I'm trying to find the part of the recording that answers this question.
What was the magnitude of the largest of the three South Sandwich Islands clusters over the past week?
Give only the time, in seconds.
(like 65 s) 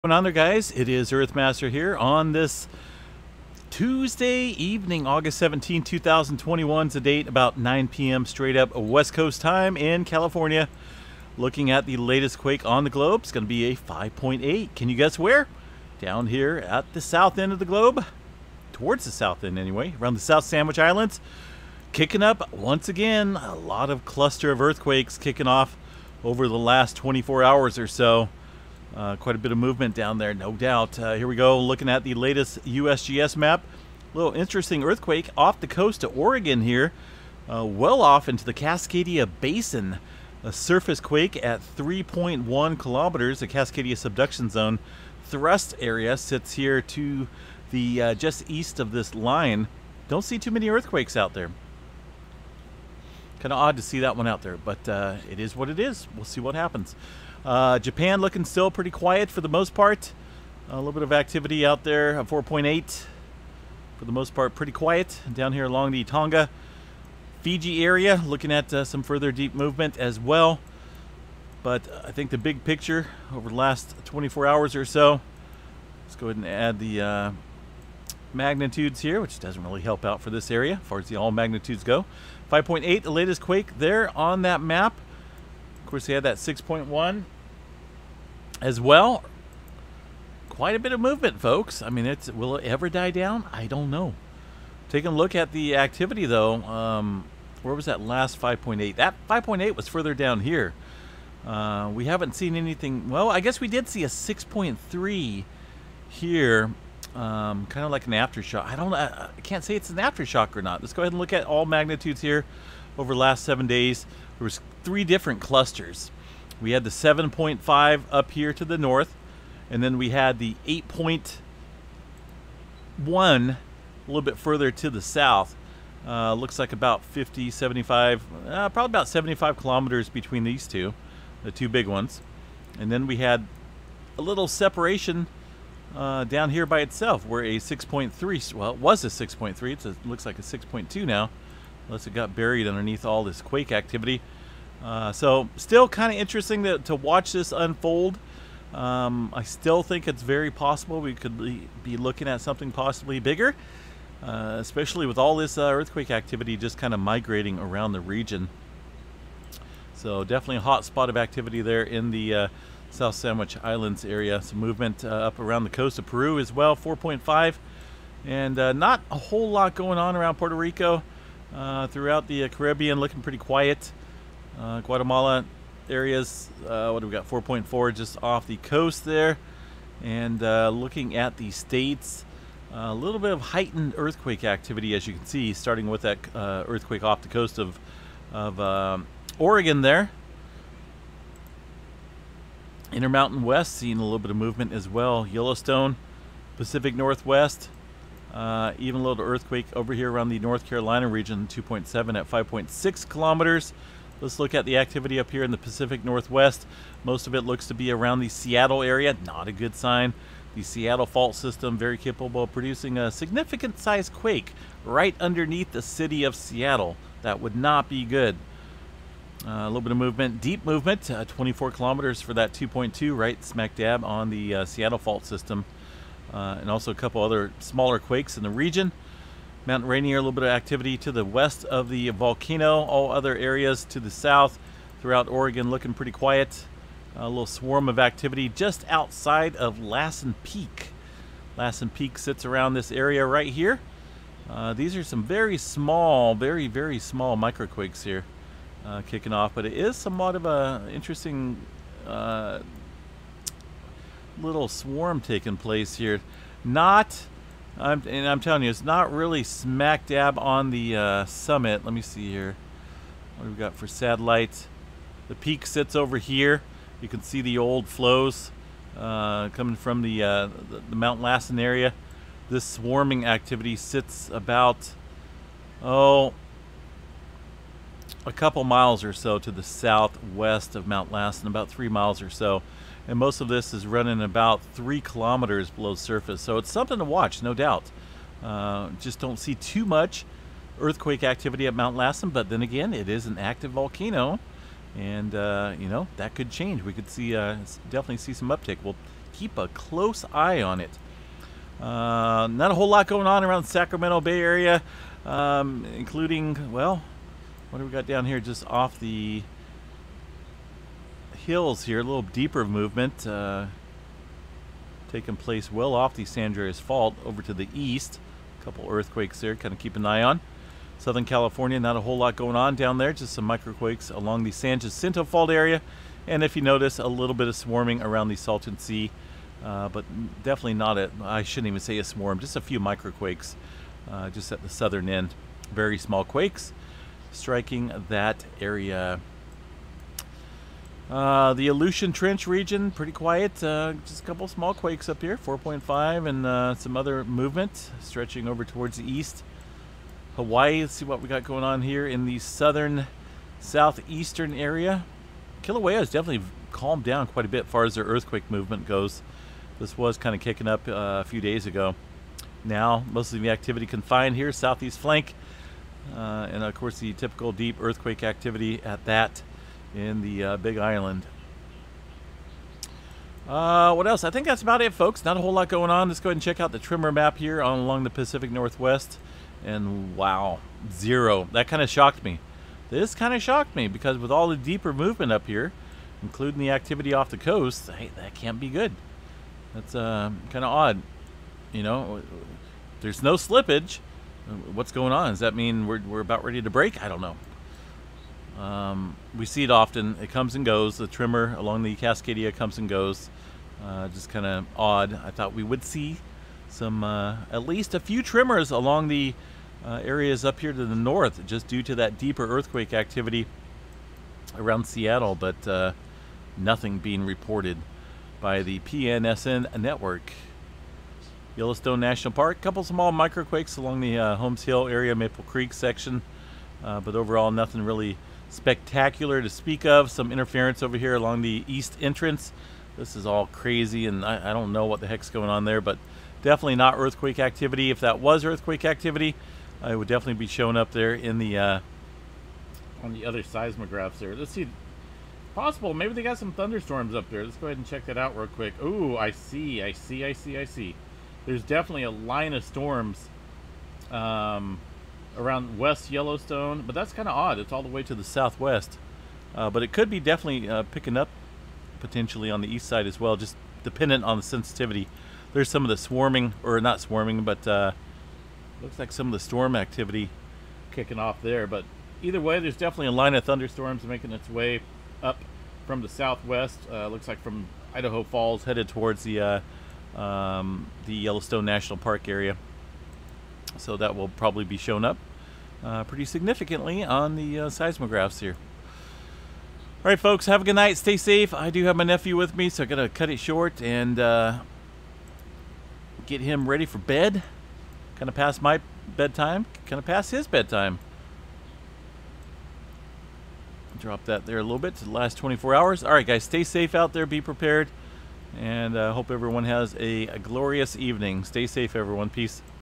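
120 s.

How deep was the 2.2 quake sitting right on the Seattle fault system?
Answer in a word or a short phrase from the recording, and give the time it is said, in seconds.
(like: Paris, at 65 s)
24 kilometers, at 221 s.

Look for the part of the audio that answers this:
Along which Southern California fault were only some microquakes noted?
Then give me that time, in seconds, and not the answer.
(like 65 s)
324 s.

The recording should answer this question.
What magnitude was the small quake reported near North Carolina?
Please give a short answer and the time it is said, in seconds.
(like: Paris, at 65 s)
2.7, at 201 s.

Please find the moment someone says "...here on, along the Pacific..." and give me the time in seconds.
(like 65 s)
377 s.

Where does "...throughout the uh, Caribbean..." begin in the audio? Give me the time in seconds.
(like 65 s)
171 s.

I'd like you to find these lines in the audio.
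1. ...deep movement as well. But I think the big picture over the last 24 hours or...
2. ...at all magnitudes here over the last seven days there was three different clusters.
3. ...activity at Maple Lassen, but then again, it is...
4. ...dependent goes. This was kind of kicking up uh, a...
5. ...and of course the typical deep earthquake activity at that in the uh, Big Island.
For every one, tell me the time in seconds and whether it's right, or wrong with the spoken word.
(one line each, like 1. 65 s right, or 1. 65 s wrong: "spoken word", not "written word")
1. 69 s right
2. 111 s right
3. 291 s wrong: "Mount", not "Maple"
4. 358 s wrong: "movement", not "dependent"
5. 366 s right.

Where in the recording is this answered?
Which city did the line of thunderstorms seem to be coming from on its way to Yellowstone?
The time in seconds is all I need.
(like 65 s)
477 s.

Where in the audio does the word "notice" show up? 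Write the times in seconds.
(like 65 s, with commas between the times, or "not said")
326 s.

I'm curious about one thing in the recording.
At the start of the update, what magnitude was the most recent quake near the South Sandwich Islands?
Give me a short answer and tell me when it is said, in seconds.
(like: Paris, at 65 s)
5.8, at 13 s.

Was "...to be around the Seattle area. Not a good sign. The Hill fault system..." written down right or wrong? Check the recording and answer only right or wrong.
wrong.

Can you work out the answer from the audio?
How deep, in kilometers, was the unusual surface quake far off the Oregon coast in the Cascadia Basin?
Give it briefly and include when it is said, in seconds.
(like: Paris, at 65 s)
3.1 kilometers, at 41 s.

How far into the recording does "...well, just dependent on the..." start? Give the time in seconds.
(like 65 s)
463 s.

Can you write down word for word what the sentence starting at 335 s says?
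Very small quakes striking that area.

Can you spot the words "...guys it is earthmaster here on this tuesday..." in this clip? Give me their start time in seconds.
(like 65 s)
0 s.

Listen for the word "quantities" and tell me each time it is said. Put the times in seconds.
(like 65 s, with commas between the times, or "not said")
not said.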